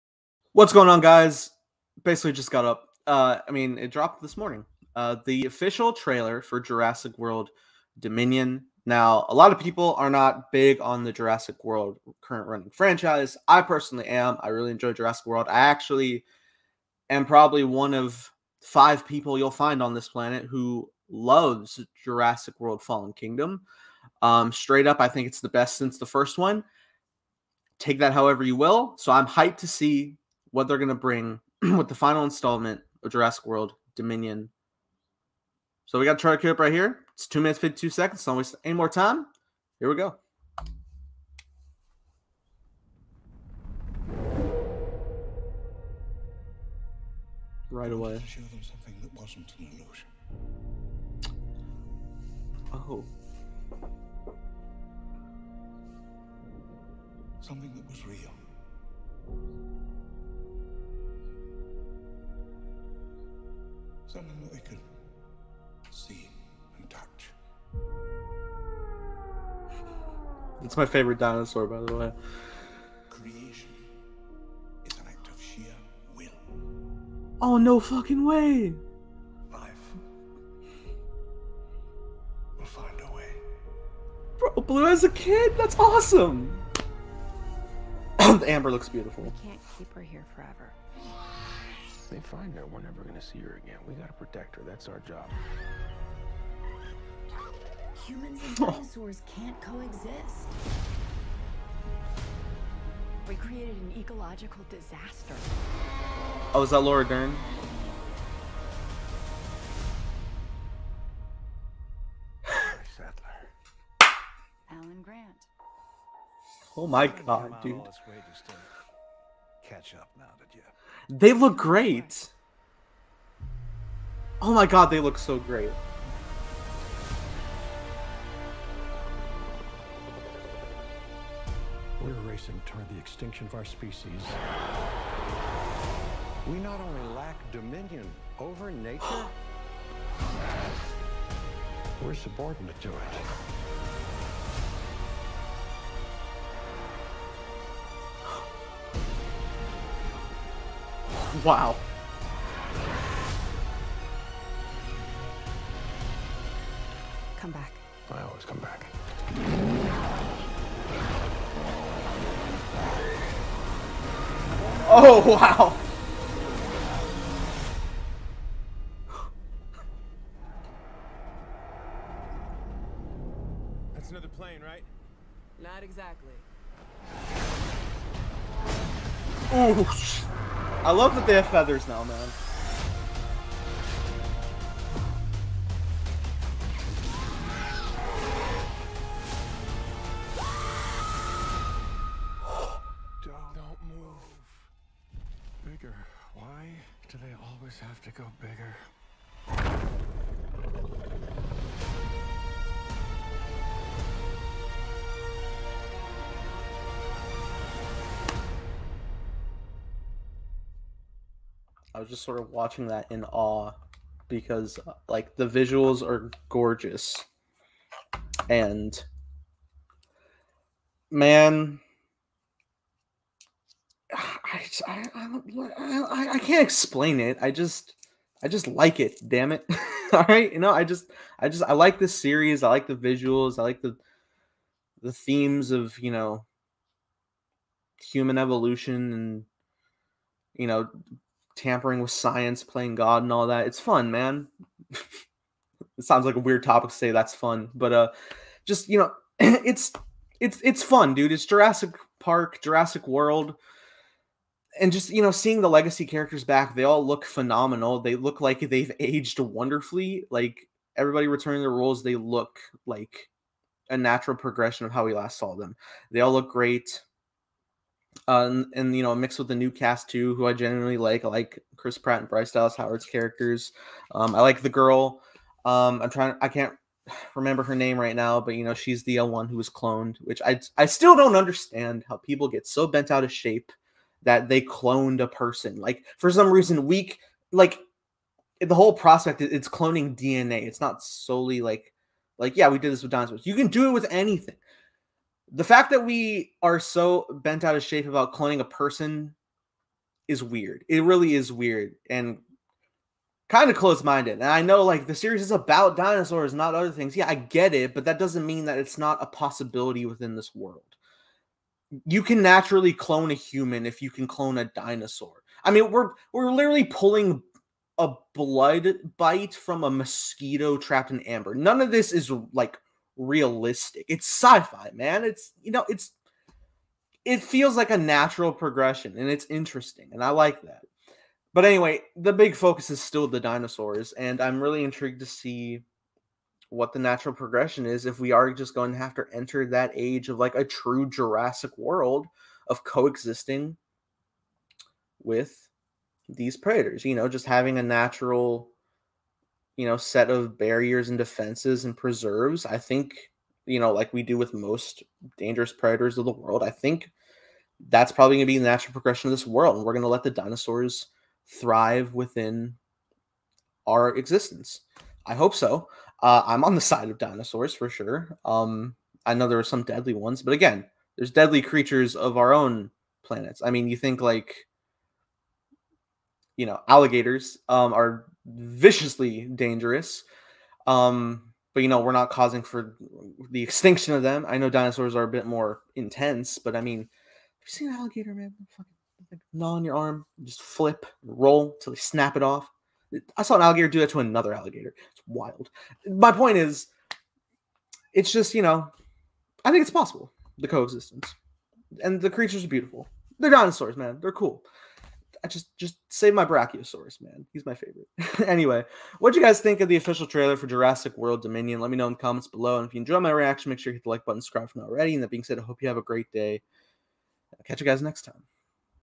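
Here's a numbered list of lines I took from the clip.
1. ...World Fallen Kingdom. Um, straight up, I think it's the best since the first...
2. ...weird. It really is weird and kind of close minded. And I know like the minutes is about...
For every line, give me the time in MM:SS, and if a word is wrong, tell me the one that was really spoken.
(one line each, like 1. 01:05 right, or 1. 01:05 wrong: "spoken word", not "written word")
1. 00:22 right
2. 05:00 wrong: "series", not "minutes".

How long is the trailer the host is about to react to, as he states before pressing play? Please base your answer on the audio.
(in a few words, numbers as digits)
2 minutes 52 seconds.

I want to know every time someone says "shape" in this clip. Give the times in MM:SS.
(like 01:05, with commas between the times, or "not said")
04:43, 04:57.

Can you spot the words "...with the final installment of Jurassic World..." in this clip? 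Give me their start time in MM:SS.
00:31.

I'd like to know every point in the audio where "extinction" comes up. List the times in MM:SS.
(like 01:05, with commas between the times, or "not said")
02:12, 06:23.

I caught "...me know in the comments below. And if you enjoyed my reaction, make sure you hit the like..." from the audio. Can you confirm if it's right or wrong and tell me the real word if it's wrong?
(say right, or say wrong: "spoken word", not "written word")
right.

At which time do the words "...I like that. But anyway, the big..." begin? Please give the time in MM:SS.
05:30.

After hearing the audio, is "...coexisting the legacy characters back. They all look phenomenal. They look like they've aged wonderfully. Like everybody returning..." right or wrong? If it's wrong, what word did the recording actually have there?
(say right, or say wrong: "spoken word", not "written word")
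wrong: "seeing", not "coexisting".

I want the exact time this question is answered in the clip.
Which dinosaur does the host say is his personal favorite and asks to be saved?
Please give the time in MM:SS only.
06:46.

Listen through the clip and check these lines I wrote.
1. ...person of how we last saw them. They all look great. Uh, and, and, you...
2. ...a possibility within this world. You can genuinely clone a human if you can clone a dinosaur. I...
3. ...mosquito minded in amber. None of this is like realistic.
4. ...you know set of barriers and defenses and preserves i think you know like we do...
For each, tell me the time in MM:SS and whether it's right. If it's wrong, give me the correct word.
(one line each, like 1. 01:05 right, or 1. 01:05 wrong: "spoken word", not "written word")
1. 04:24 wrong: "progression", not "person"
2. 05:09 wrong: "naturally", not "genuinely"
3. 05:19 wrong: "trapped", not "minded"
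4. 05:49 right.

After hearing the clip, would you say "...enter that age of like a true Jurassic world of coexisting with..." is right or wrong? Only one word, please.
right.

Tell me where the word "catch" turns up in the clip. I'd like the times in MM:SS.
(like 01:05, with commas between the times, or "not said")
01:59, 06:57.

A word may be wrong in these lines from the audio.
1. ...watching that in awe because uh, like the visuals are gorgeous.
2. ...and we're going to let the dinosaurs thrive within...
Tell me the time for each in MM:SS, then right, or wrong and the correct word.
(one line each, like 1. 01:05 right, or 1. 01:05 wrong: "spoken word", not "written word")
1. 03:32 right
2. 05:59 right.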